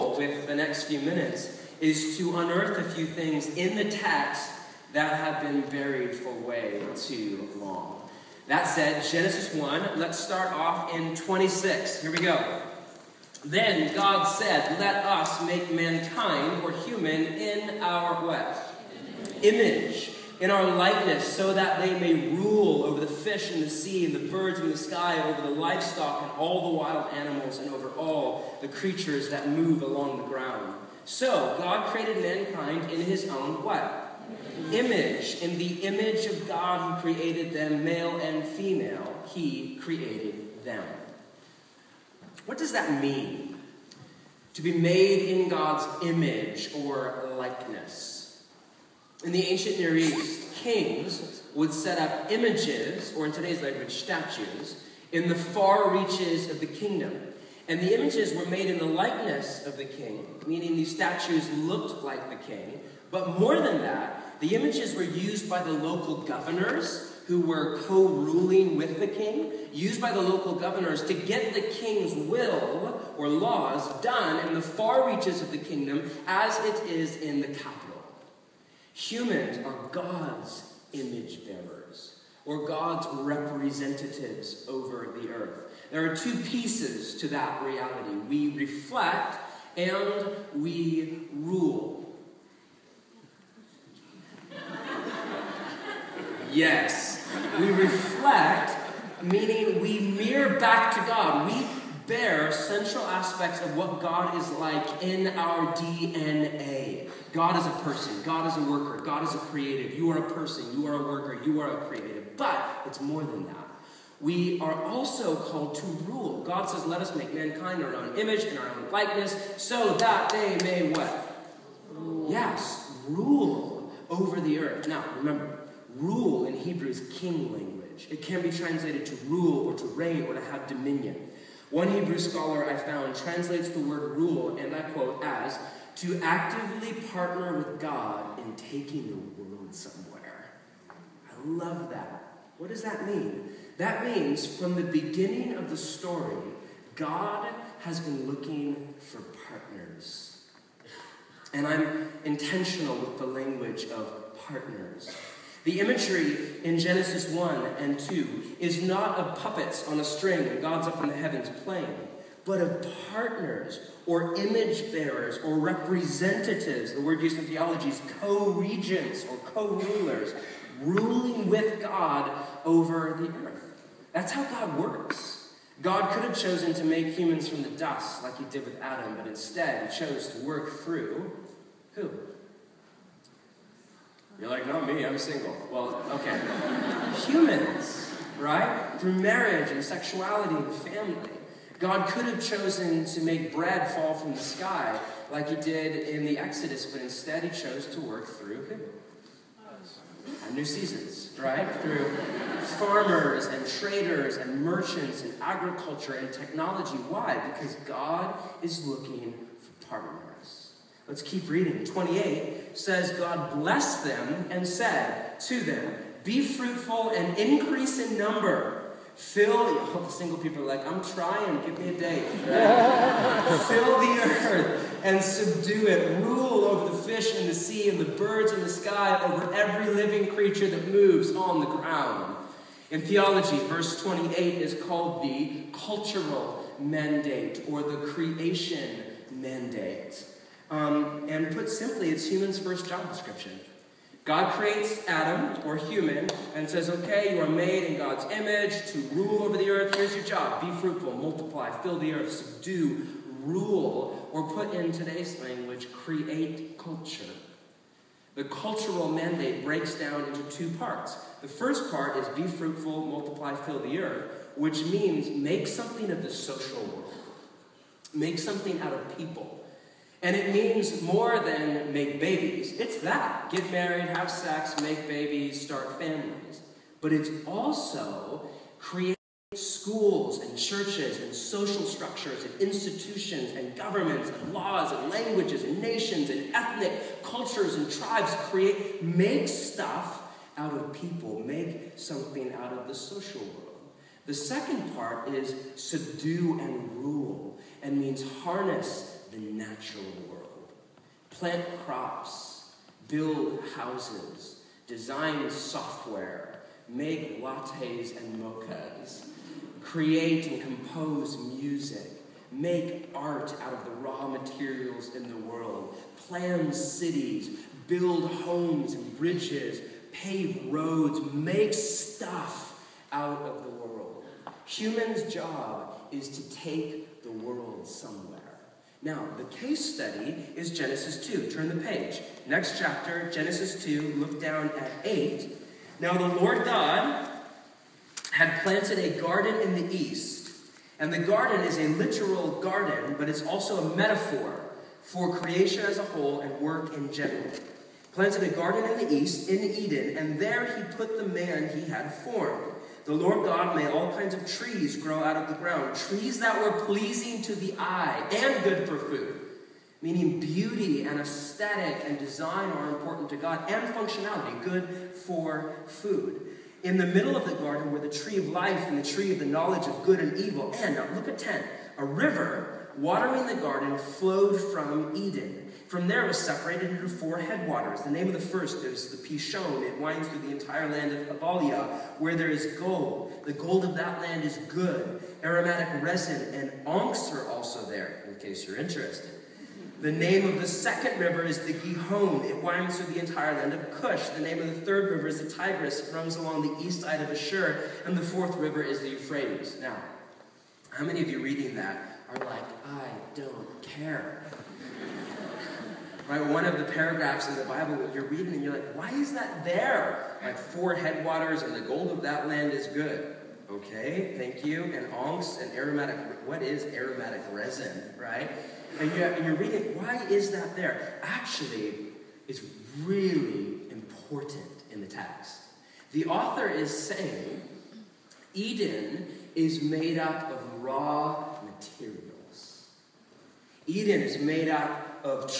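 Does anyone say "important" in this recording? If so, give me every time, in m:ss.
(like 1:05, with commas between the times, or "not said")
6:02, 7:03.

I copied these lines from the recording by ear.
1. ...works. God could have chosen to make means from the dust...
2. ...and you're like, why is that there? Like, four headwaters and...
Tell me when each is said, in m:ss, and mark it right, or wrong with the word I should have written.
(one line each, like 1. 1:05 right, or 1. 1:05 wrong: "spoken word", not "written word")
1. 2:54 wrong: "humans", not "means"
2. 6:48 right.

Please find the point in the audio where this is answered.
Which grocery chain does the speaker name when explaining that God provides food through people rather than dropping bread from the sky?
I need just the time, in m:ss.
3:20.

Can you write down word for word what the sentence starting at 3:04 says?
You're like, not me, I'm single.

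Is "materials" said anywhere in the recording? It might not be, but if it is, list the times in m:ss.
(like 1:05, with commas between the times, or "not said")
5:14, 7:11.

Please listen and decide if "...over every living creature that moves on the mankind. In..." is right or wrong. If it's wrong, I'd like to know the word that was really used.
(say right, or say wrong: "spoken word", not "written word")
wrong: "ground", not "mankind".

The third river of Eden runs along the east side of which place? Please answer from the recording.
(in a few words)
Ashur.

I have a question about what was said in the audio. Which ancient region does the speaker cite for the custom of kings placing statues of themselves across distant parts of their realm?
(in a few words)
Ancient Near East.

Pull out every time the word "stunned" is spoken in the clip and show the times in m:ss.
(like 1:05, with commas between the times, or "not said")
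not said.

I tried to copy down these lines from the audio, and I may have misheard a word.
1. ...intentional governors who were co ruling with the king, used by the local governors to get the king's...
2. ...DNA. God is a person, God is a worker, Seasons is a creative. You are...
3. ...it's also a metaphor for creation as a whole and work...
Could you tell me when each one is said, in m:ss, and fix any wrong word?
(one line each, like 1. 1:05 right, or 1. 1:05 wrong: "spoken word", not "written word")
1. 1:05 wrong: "local", not "intentional"
2. 1:45 wrong: "God", not "Seasons"
3. 5:43 right.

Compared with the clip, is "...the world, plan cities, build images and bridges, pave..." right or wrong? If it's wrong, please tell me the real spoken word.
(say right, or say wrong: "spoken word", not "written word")
wrong: "homes", not "images".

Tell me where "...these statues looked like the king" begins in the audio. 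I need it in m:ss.
1:00.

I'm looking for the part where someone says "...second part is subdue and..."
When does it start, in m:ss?
4:54.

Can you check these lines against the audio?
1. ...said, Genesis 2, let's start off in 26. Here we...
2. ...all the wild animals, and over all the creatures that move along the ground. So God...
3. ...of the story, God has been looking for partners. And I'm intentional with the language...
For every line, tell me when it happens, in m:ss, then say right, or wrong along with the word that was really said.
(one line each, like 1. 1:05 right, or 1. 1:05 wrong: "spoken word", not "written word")
1. 0:08 wrong: "1", not "2"
2. 0:26 right
3. 2:25 right.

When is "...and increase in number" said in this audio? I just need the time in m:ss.
3:37.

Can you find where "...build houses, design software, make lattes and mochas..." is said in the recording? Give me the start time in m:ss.
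5:03.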